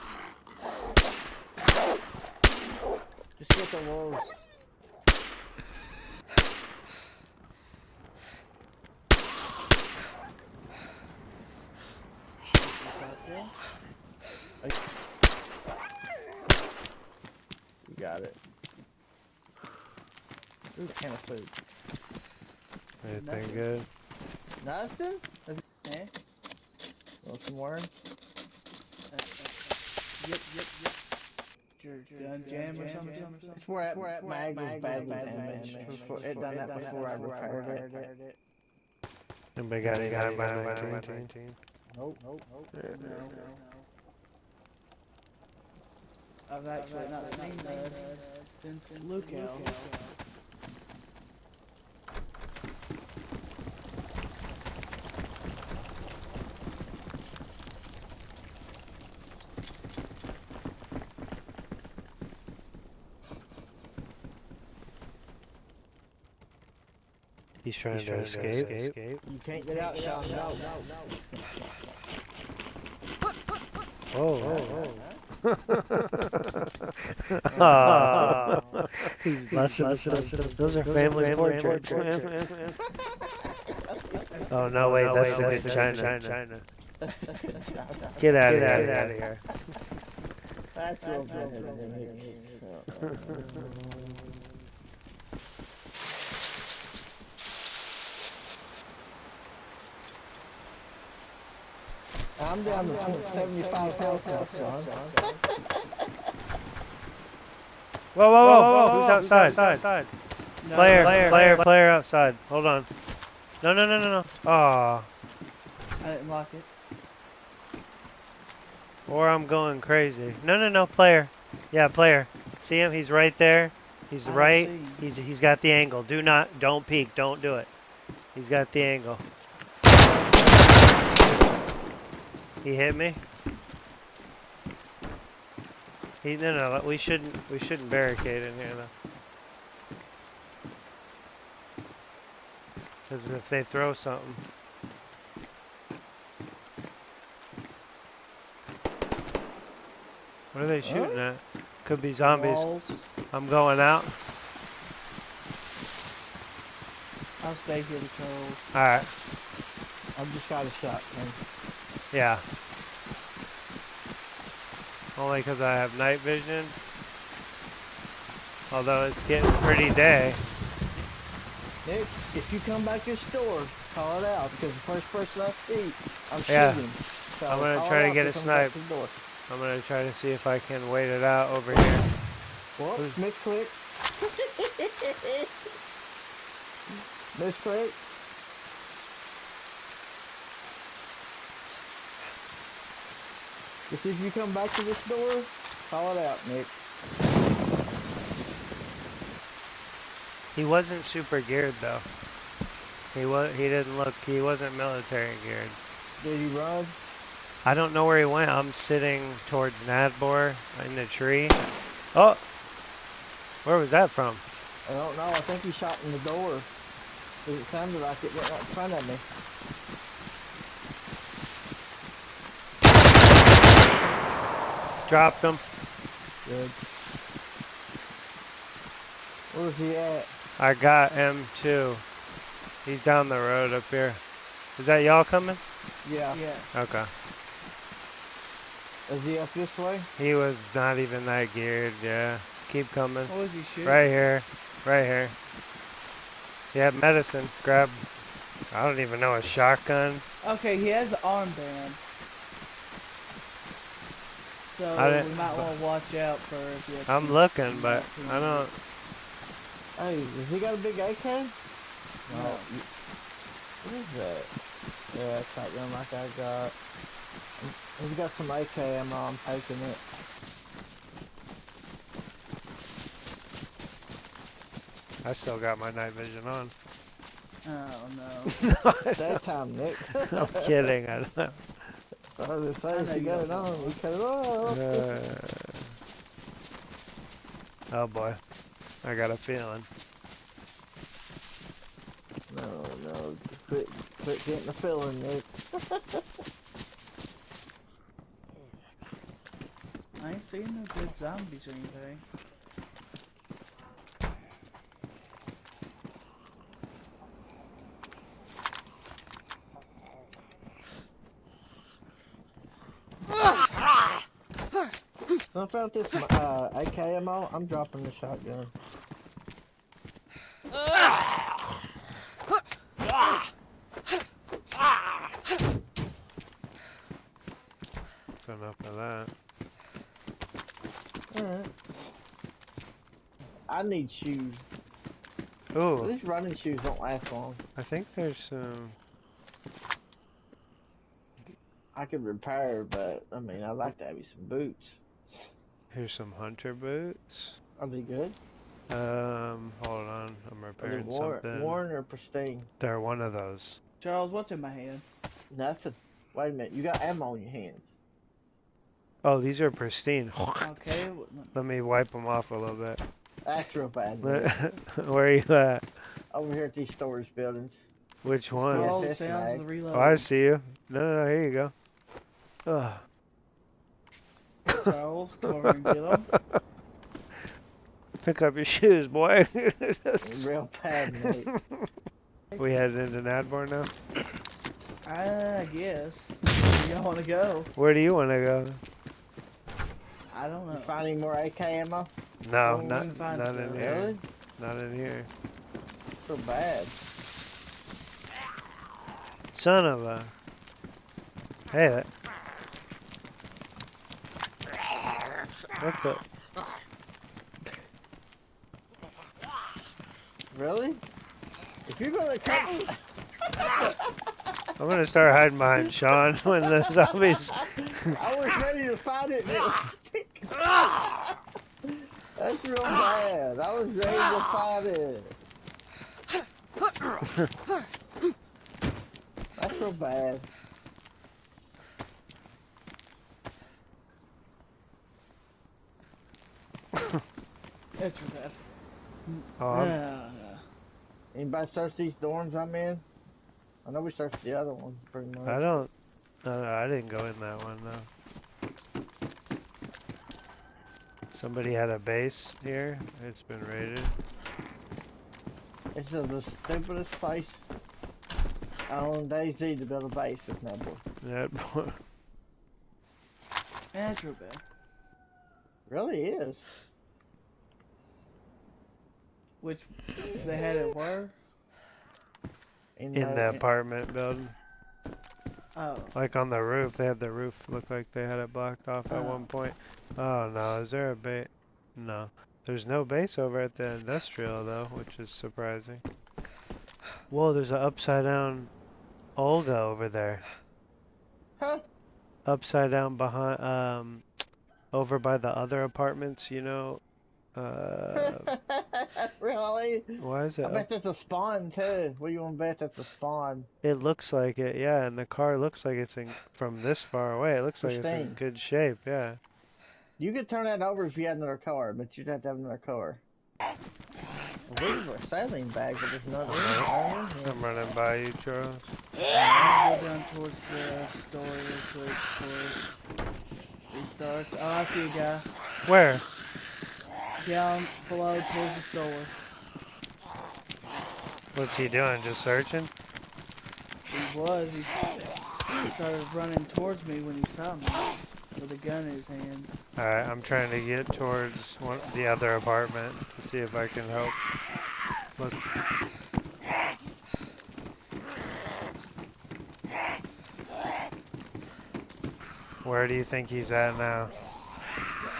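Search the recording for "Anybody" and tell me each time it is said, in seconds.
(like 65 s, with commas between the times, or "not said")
39 s, 441 s.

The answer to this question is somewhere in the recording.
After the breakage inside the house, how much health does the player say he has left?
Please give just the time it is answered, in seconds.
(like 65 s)
103 s.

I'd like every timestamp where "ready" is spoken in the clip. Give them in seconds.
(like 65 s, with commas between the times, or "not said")
418 s, 423 s.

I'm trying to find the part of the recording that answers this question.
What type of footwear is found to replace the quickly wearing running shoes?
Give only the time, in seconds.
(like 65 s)
346 s.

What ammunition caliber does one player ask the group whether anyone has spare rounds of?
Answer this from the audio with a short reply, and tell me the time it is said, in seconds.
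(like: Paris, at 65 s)
9x19, at 40 s.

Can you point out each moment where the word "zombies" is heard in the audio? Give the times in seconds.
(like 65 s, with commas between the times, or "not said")
152 s, 301 s, 416 s.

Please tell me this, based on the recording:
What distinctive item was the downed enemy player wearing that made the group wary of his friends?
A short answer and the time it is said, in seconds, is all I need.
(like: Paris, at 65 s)
an armband, at 251 s.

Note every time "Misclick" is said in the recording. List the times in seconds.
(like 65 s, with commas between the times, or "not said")
182 s, 187 s.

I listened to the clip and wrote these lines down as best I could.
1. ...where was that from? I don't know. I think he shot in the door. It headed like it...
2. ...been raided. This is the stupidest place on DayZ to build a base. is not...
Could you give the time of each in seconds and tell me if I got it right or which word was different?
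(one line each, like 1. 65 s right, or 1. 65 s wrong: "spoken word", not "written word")
1. 213 s wrong: "sounded", not "headed"
2. 453 s right.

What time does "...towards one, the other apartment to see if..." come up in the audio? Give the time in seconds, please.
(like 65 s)
541 s.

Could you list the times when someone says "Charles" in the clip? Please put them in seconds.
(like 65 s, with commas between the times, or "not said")
354 s, 518 s.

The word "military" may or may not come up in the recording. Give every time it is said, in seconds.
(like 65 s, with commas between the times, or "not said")
204 s.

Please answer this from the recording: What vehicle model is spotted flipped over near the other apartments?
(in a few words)
Olga.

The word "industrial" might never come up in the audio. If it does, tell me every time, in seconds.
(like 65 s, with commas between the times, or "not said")
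483 s.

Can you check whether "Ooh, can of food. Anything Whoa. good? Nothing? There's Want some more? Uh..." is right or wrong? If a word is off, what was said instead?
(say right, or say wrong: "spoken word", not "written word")
wrong: "Nothing", not "Whoa".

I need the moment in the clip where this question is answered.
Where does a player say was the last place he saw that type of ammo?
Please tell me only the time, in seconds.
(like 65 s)
49 s.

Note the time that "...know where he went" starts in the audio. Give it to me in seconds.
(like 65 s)
207 s.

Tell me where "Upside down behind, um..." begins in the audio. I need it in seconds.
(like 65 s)
492 s.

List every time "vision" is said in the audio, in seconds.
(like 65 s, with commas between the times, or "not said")
166 s, 276 s.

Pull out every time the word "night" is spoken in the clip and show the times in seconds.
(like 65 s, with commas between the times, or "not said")
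165 s, 275 s.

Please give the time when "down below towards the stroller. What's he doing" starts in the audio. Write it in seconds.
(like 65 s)
527 s.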